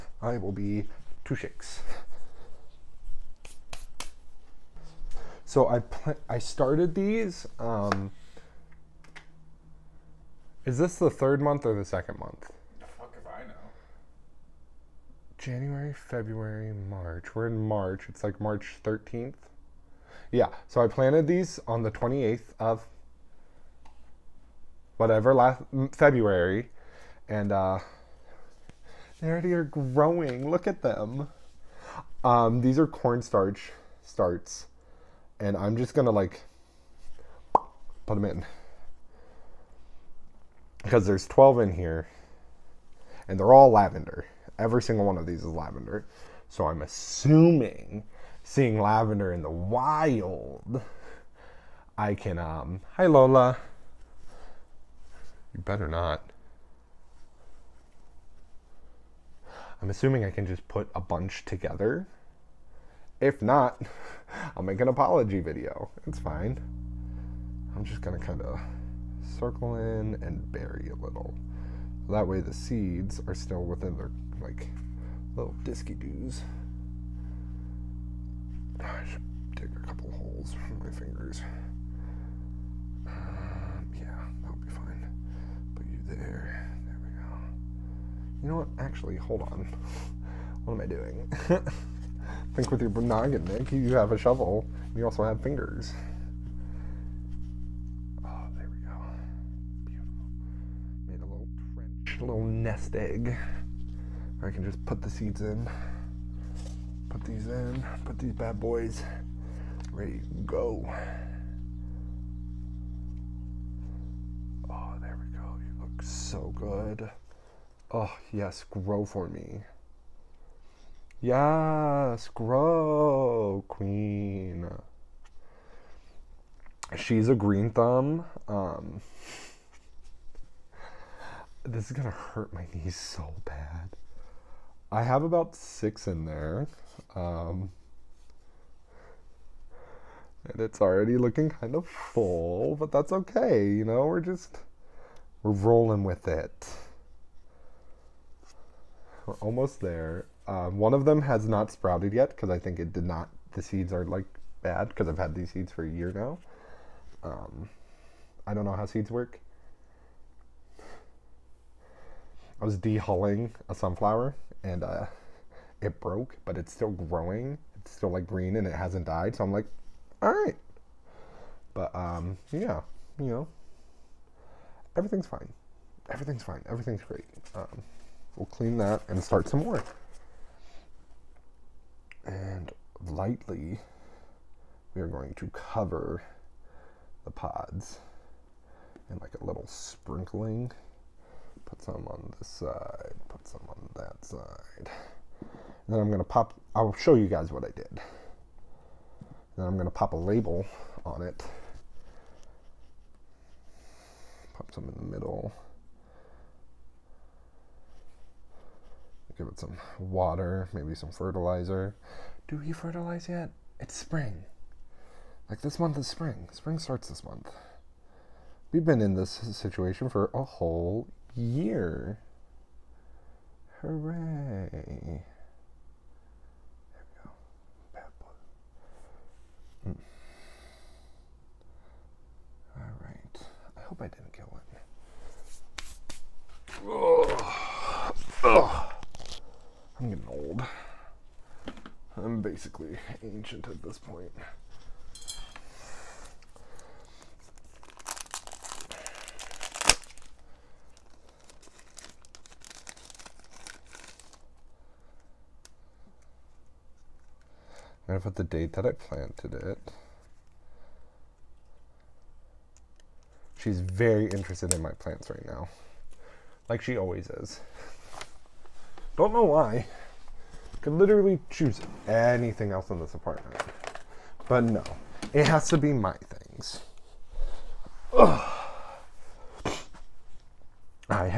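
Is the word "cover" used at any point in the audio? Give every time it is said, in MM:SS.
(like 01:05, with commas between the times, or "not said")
03:05.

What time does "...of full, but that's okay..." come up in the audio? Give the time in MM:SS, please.
02:21.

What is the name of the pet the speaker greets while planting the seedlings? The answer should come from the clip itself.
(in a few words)
Lola.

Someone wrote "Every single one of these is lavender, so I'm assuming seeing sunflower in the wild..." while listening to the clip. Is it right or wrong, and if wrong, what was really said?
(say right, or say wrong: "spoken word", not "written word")
wrong: "lavender", not "sunflower".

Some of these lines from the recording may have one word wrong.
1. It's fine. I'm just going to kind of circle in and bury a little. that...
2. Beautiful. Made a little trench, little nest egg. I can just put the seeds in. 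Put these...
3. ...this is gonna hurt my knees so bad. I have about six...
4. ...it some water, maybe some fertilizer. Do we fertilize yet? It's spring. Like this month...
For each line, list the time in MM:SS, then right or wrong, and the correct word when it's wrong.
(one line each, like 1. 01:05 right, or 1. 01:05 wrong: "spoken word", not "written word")
1. 01:06 right
2. 01:41 right
3. 02:11 right
4. 03:29 right.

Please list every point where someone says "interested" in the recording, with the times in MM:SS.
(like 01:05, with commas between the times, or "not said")
04:24.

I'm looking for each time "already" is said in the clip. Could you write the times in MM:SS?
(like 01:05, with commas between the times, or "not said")
00:29, 02:20.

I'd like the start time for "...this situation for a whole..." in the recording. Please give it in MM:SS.
03:39.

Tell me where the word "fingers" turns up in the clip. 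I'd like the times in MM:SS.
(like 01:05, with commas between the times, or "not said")
01:20, 01:35.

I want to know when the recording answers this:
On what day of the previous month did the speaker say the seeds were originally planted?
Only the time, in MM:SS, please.
00:21.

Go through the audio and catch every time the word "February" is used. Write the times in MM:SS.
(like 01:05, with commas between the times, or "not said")
00:15, 00:25.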